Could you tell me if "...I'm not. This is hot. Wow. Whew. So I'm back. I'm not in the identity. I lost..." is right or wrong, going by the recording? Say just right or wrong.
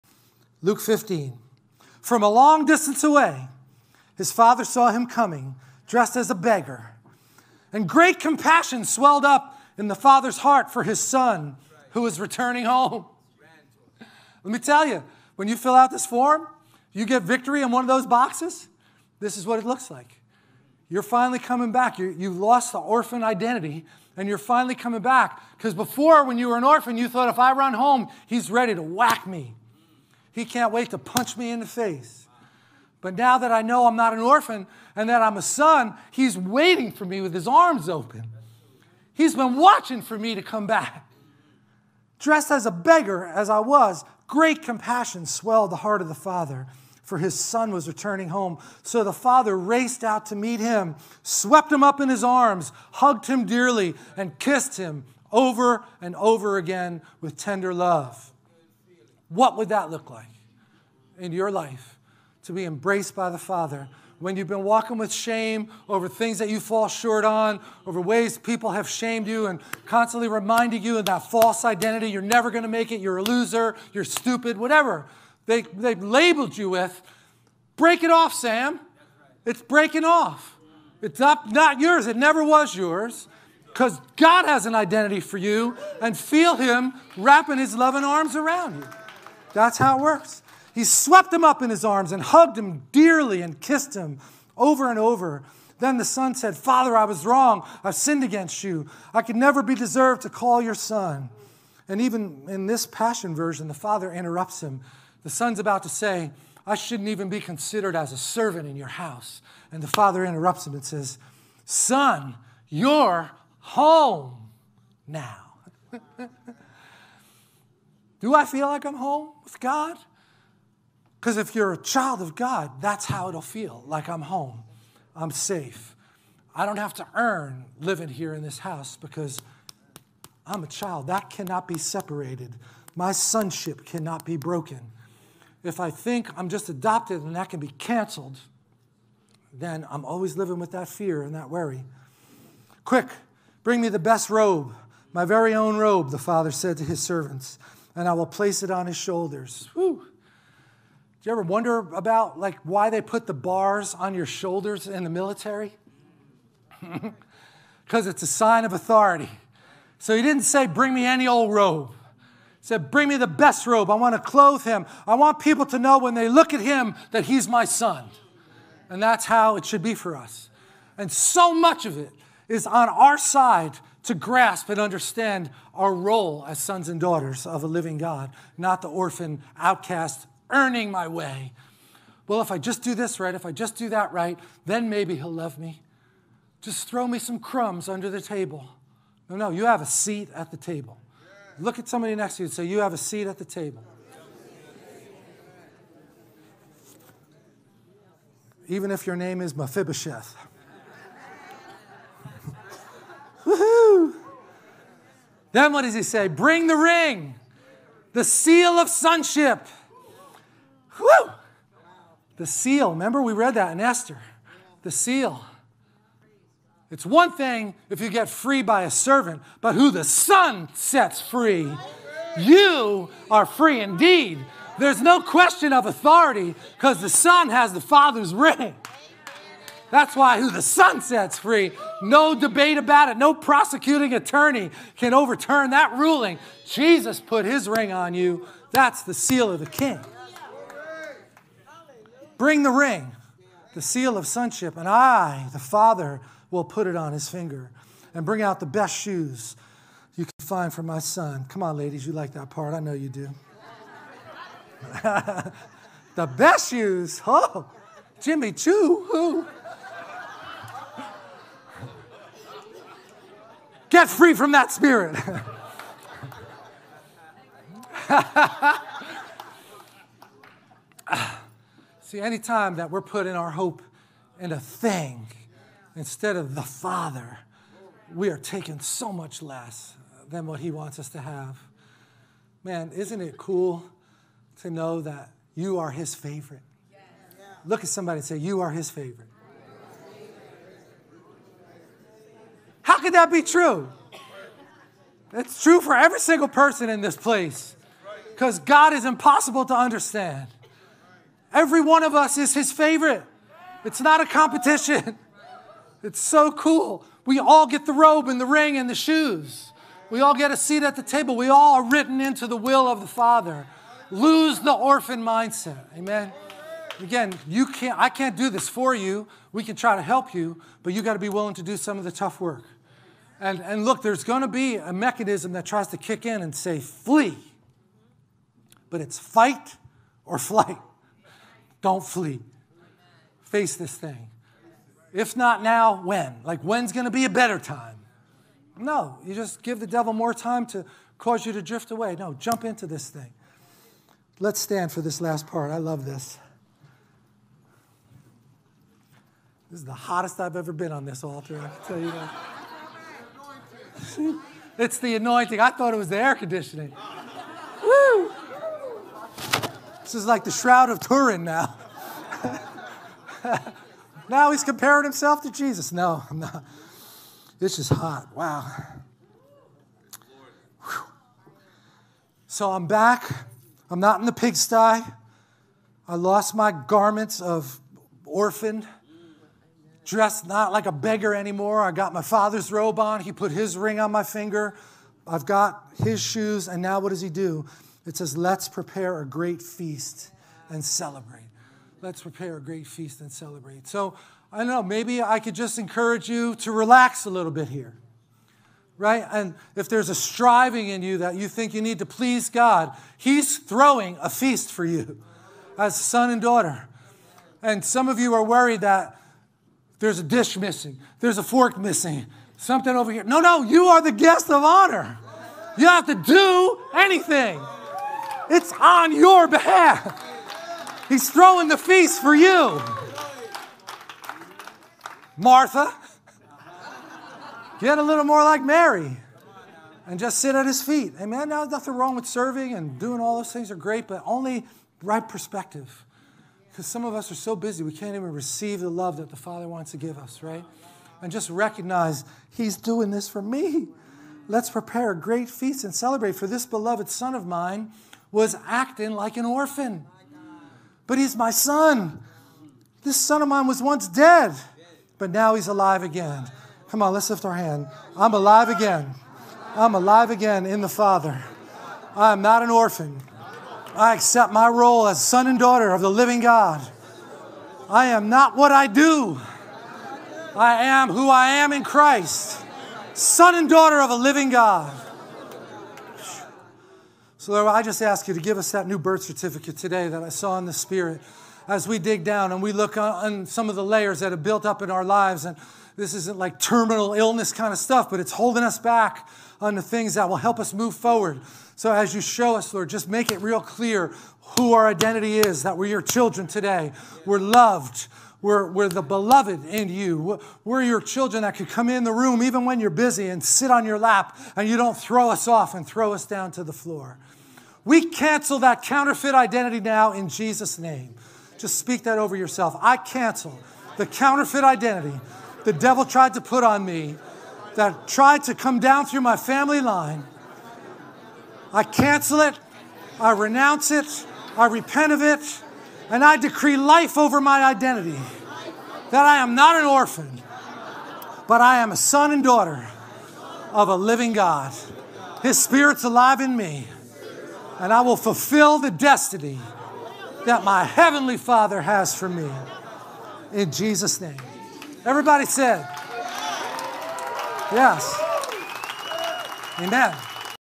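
wrong.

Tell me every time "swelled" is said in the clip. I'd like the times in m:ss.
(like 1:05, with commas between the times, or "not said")
0:08, 0:45.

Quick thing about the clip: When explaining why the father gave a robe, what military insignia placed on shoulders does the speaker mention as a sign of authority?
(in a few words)
Bars.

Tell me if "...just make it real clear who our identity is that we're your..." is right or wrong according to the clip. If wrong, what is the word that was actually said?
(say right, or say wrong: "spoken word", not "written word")
right.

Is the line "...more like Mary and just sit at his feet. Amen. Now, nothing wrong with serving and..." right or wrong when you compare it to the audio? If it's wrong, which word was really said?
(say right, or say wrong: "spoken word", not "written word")
right.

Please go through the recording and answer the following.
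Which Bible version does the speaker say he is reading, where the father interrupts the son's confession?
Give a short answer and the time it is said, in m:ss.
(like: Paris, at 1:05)
Passion version, at 1:42.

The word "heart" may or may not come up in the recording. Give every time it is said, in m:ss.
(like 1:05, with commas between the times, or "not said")
0:10, 0:45.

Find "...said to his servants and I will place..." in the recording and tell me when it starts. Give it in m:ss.
2:26.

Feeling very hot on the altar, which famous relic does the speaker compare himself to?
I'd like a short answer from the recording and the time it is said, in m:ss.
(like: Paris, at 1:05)
Shroud of Turin, at 6:00.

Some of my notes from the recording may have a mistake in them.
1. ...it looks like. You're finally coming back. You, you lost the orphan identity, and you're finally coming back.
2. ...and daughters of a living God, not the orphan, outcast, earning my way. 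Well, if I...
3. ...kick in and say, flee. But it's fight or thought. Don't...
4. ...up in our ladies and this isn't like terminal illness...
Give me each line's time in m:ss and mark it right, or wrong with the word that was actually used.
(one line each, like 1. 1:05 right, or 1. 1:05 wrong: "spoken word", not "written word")
1. 0:19 right
2. 2:56 right
3. 5:25 wrong: "flight", not "thought"
4. 8:04 wrong: "lives", not "ladies".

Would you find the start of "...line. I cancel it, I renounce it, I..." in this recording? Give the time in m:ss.
8:39.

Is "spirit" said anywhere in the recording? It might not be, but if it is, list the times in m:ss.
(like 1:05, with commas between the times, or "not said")
4:24, 8:00, 8:55.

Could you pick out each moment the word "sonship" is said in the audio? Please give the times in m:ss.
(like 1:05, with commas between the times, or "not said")
2:13, 3:28, 4:04.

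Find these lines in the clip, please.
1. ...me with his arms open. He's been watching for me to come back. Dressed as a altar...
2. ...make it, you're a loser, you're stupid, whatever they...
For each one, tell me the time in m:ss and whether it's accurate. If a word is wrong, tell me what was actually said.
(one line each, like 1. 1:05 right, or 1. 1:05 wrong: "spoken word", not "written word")
1. 0:37 wrong: "beggar", not "altar"
2. 1:12 right.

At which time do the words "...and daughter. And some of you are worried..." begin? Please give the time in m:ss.
6:46.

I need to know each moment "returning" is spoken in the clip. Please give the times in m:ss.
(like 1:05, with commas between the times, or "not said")
0:12, 0:47.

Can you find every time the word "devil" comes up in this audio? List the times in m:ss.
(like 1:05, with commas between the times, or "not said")
5:39, 8:35.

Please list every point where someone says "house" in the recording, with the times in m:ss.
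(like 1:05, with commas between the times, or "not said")
1:48, 2:08.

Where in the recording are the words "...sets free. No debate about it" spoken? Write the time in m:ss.
3:51.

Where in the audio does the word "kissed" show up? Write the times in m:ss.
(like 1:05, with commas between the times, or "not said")
0:54, 1:33.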